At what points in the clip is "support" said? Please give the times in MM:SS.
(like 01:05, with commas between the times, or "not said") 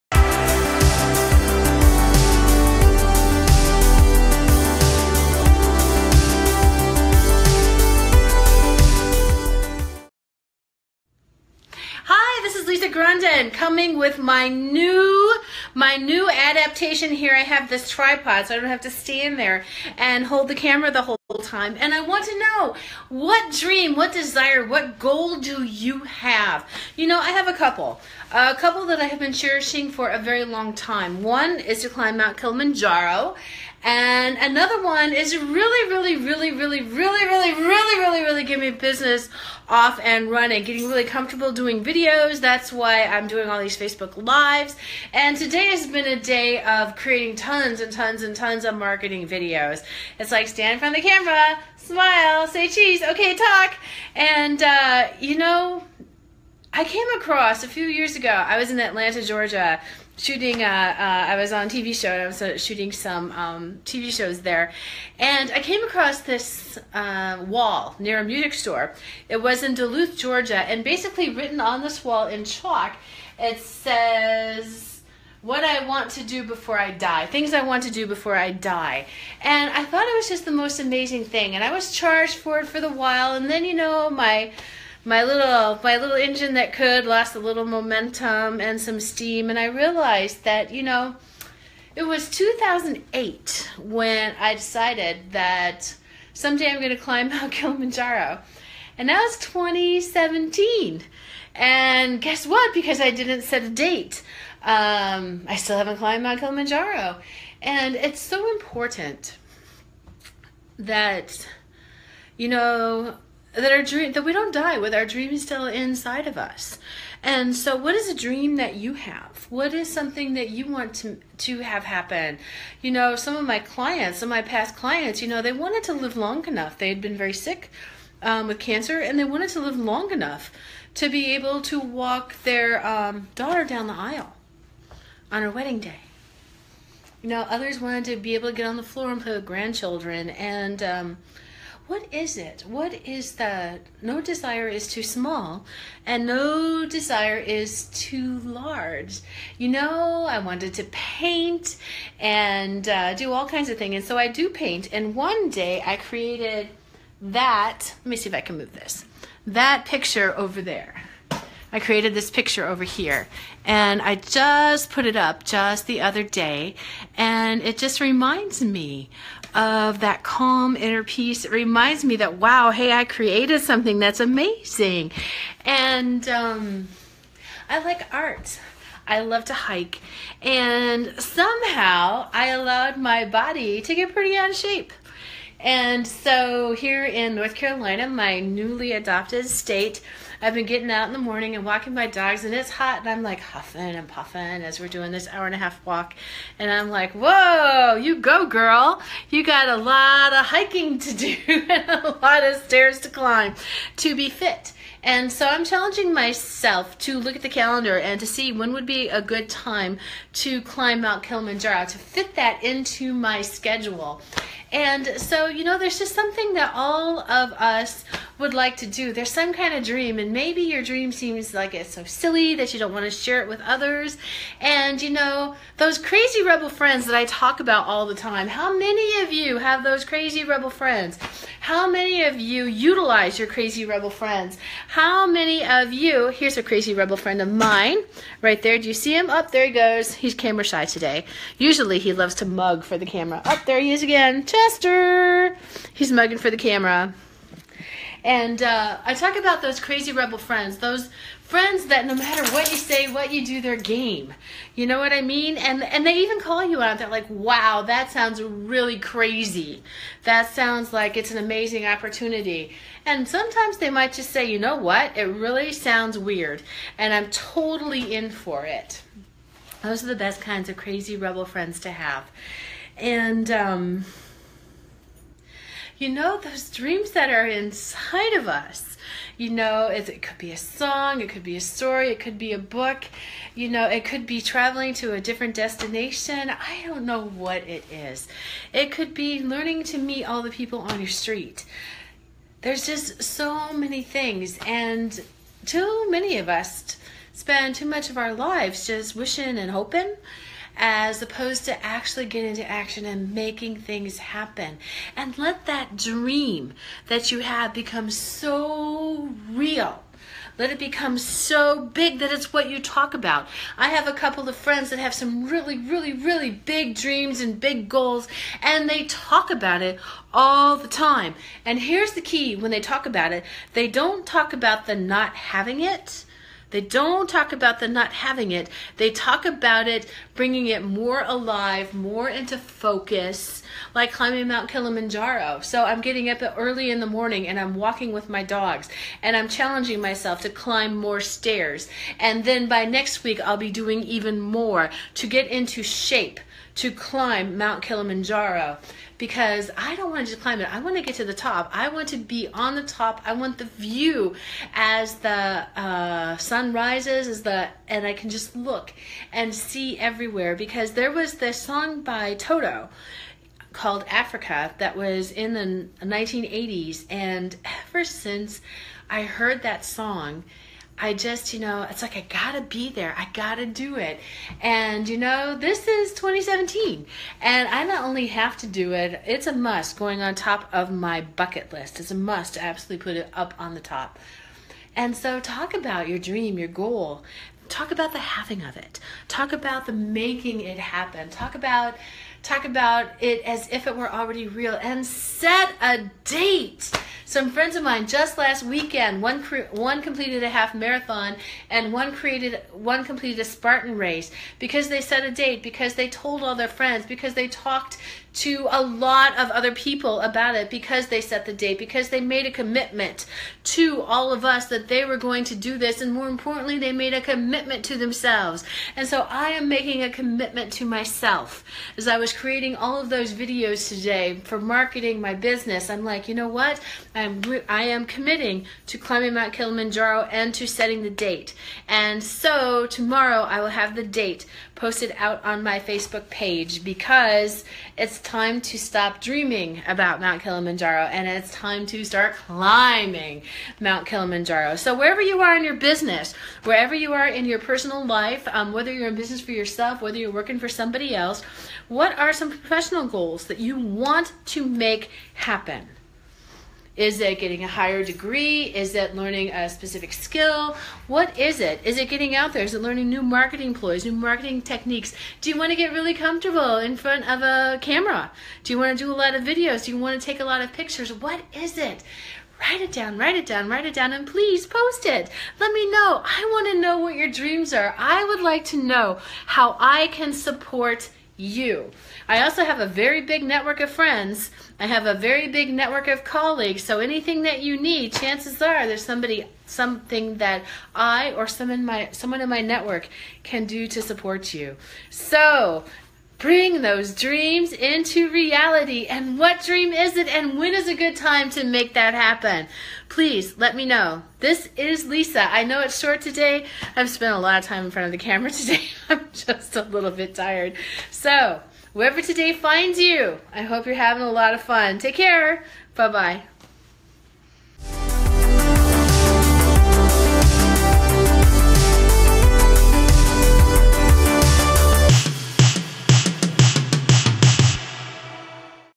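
08:00, 08:14.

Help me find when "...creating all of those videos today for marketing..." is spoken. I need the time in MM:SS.
07:02.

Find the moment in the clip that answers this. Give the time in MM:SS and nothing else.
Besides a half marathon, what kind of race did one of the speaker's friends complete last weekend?
06:43.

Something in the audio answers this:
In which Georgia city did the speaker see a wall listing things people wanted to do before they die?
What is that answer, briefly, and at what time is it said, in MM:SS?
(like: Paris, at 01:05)
Duluth, at 01:09.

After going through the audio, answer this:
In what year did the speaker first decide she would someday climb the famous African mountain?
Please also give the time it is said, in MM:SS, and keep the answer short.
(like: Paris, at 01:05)
2008, at 01:32.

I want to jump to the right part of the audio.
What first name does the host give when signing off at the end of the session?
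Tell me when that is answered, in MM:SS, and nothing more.
08:25.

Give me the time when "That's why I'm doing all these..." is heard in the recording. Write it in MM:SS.
00:42.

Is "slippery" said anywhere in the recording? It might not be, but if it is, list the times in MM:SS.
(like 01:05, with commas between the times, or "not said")
not said.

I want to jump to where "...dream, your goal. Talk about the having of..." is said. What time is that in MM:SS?
06:26.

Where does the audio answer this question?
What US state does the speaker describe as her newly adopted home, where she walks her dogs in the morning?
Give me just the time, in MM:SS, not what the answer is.
03:07.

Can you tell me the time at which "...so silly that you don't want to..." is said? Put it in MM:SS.
03:41.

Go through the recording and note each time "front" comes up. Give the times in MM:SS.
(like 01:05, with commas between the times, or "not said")
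00:50, 07:46, 08:27.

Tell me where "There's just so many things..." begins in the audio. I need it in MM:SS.
04:52.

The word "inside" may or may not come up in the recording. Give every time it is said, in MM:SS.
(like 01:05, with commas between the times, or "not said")
01:55, 04:37.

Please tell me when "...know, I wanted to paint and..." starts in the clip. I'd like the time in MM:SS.
02:29.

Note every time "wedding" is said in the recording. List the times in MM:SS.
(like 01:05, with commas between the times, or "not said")
02:15.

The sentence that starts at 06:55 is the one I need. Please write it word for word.
And more importantly, they made a commitment to themselves.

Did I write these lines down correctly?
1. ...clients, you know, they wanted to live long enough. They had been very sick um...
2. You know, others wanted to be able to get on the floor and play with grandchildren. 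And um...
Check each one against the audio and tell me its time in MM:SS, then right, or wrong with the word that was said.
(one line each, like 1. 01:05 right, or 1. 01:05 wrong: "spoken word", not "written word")
1. 02:04 right
2. 02:17 right.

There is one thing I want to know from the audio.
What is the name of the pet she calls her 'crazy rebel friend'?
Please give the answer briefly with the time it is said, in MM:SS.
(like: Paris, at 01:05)
Chester, at 04:04.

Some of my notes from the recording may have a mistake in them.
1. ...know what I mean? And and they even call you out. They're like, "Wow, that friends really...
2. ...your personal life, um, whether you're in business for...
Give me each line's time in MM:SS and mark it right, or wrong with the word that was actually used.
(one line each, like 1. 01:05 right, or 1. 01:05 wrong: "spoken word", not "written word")
1. 04:14 wrong: "sounds", not "friends"
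2. 07:27 right.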